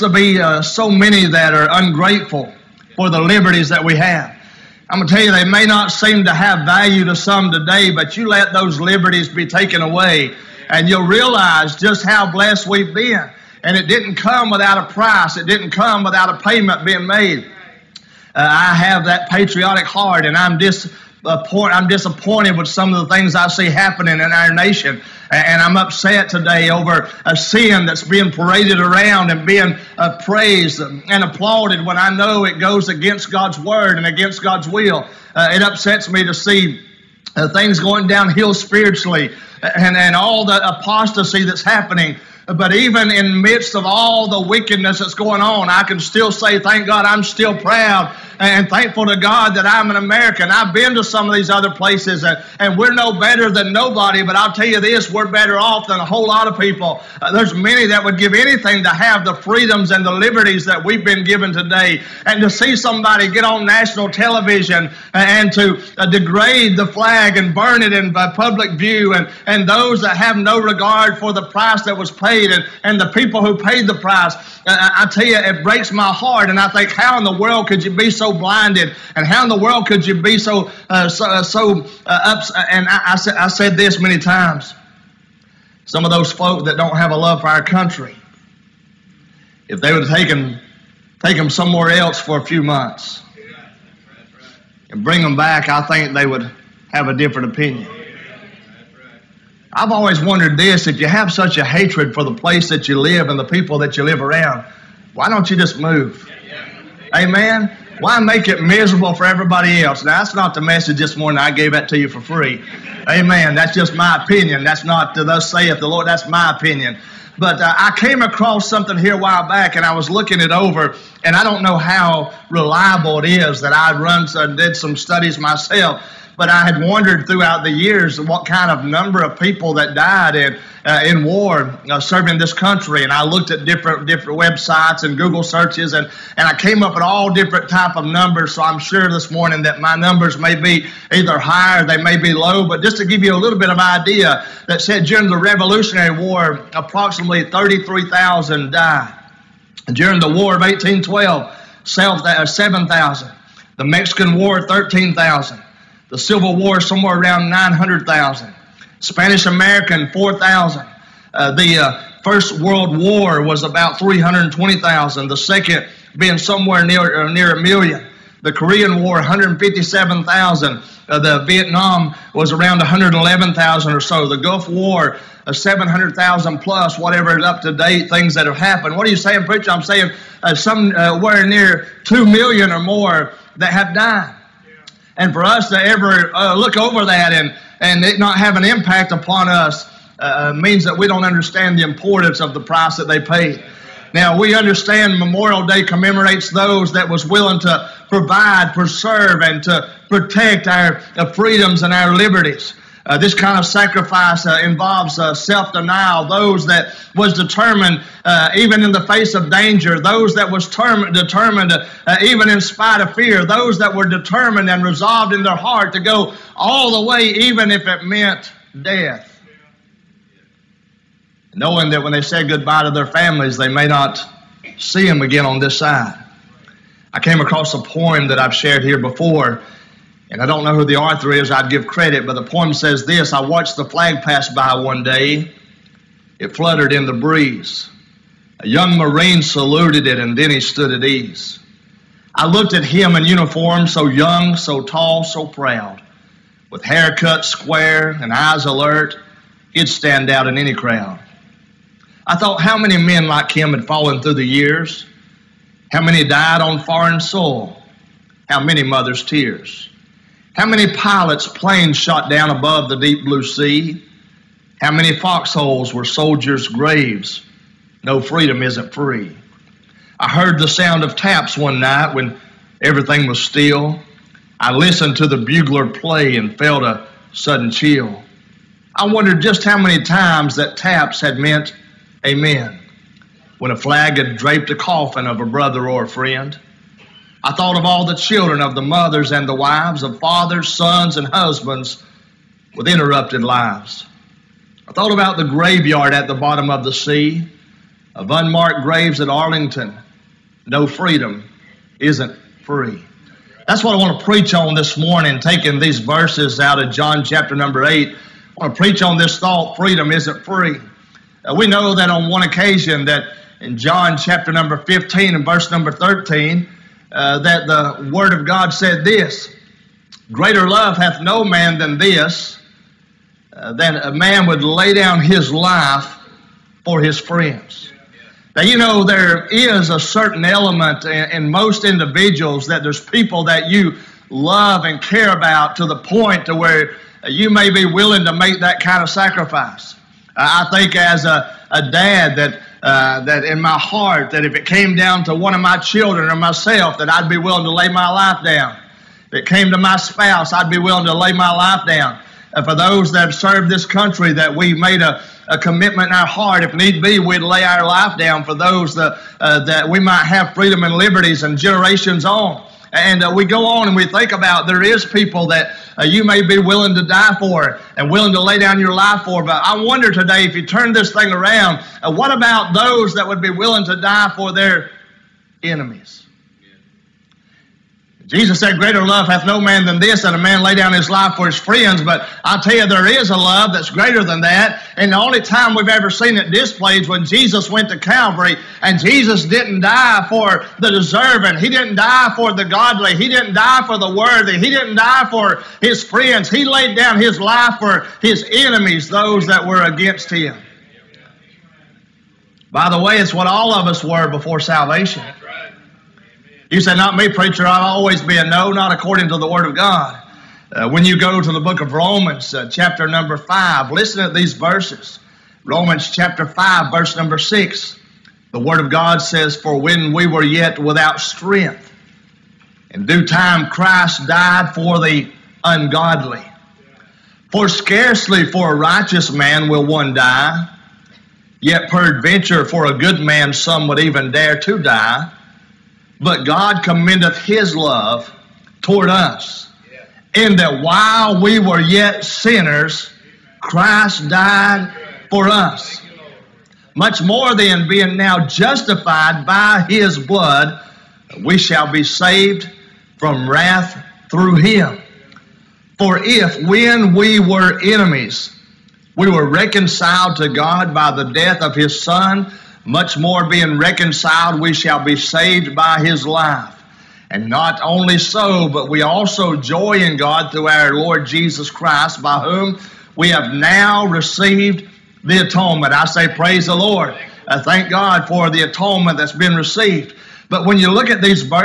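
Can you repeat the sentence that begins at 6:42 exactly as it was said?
By the way, it's what all of us were before salvation.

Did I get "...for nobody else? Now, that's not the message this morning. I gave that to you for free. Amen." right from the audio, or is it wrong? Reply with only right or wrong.
wrong.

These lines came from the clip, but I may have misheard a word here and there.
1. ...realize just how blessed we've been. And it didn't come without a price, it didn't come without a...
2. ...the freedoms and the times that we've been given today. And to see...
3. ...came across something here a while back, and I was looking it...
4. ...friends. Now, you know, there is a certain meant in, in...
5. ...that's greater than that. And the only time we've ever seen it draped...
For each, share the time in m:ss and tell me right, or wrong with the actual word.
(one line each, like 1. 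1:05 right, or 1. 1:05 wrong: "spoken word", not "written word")
1. 0:11 right
2. 0:59 wrong: "liberties", not "times"
3. 1:57 right
4. 5:27 wrong: "element", not "meant"
5. 6:23 wrong: "displayed", not "draped".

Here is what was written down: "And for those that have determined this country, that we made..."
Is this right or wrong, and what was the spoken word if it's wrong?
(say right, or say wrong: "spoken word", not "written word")
wrong: "served", not "determined".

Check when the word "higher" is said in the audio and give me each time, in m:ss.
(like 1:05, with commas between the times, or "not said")
2:21.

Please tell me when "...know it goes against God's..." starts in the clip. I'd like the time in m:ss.
0:32.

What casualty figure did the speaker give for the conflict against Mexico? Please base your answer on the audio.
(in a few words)
13,000.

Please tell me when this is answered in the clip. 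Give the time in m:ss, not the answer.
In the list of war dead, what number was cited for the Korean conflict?
2:49.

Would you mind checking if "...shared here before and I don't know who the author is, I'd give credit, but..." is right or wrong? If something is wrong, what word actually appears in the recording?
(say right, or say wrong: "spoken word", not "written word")
right.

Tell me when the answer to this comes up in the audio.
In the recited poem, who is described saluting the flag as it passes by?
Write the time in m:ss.
3:58.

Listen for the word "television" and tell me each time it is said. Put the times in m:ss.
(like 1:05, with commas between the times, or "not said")
1:04.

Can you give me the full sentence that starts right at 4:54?
I thought about the graveyard at the bottom of the sea, of unmarked graves at Arlington.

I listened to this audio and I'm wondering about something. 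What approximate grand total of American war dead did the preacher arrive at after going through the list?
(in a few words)
2 million.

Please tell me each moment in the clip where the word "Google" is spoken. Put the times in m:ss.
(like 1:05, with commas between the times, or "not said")
2:15.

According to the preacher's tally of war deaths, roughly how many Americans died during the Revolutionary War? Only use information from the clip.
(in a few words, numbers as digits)
33,000.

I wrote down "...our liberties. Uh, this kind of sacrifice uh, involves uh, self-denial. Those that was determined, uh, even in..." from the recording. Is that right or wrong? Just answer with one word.
right.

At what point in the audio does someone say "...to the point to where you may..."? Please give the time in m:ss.
5:35.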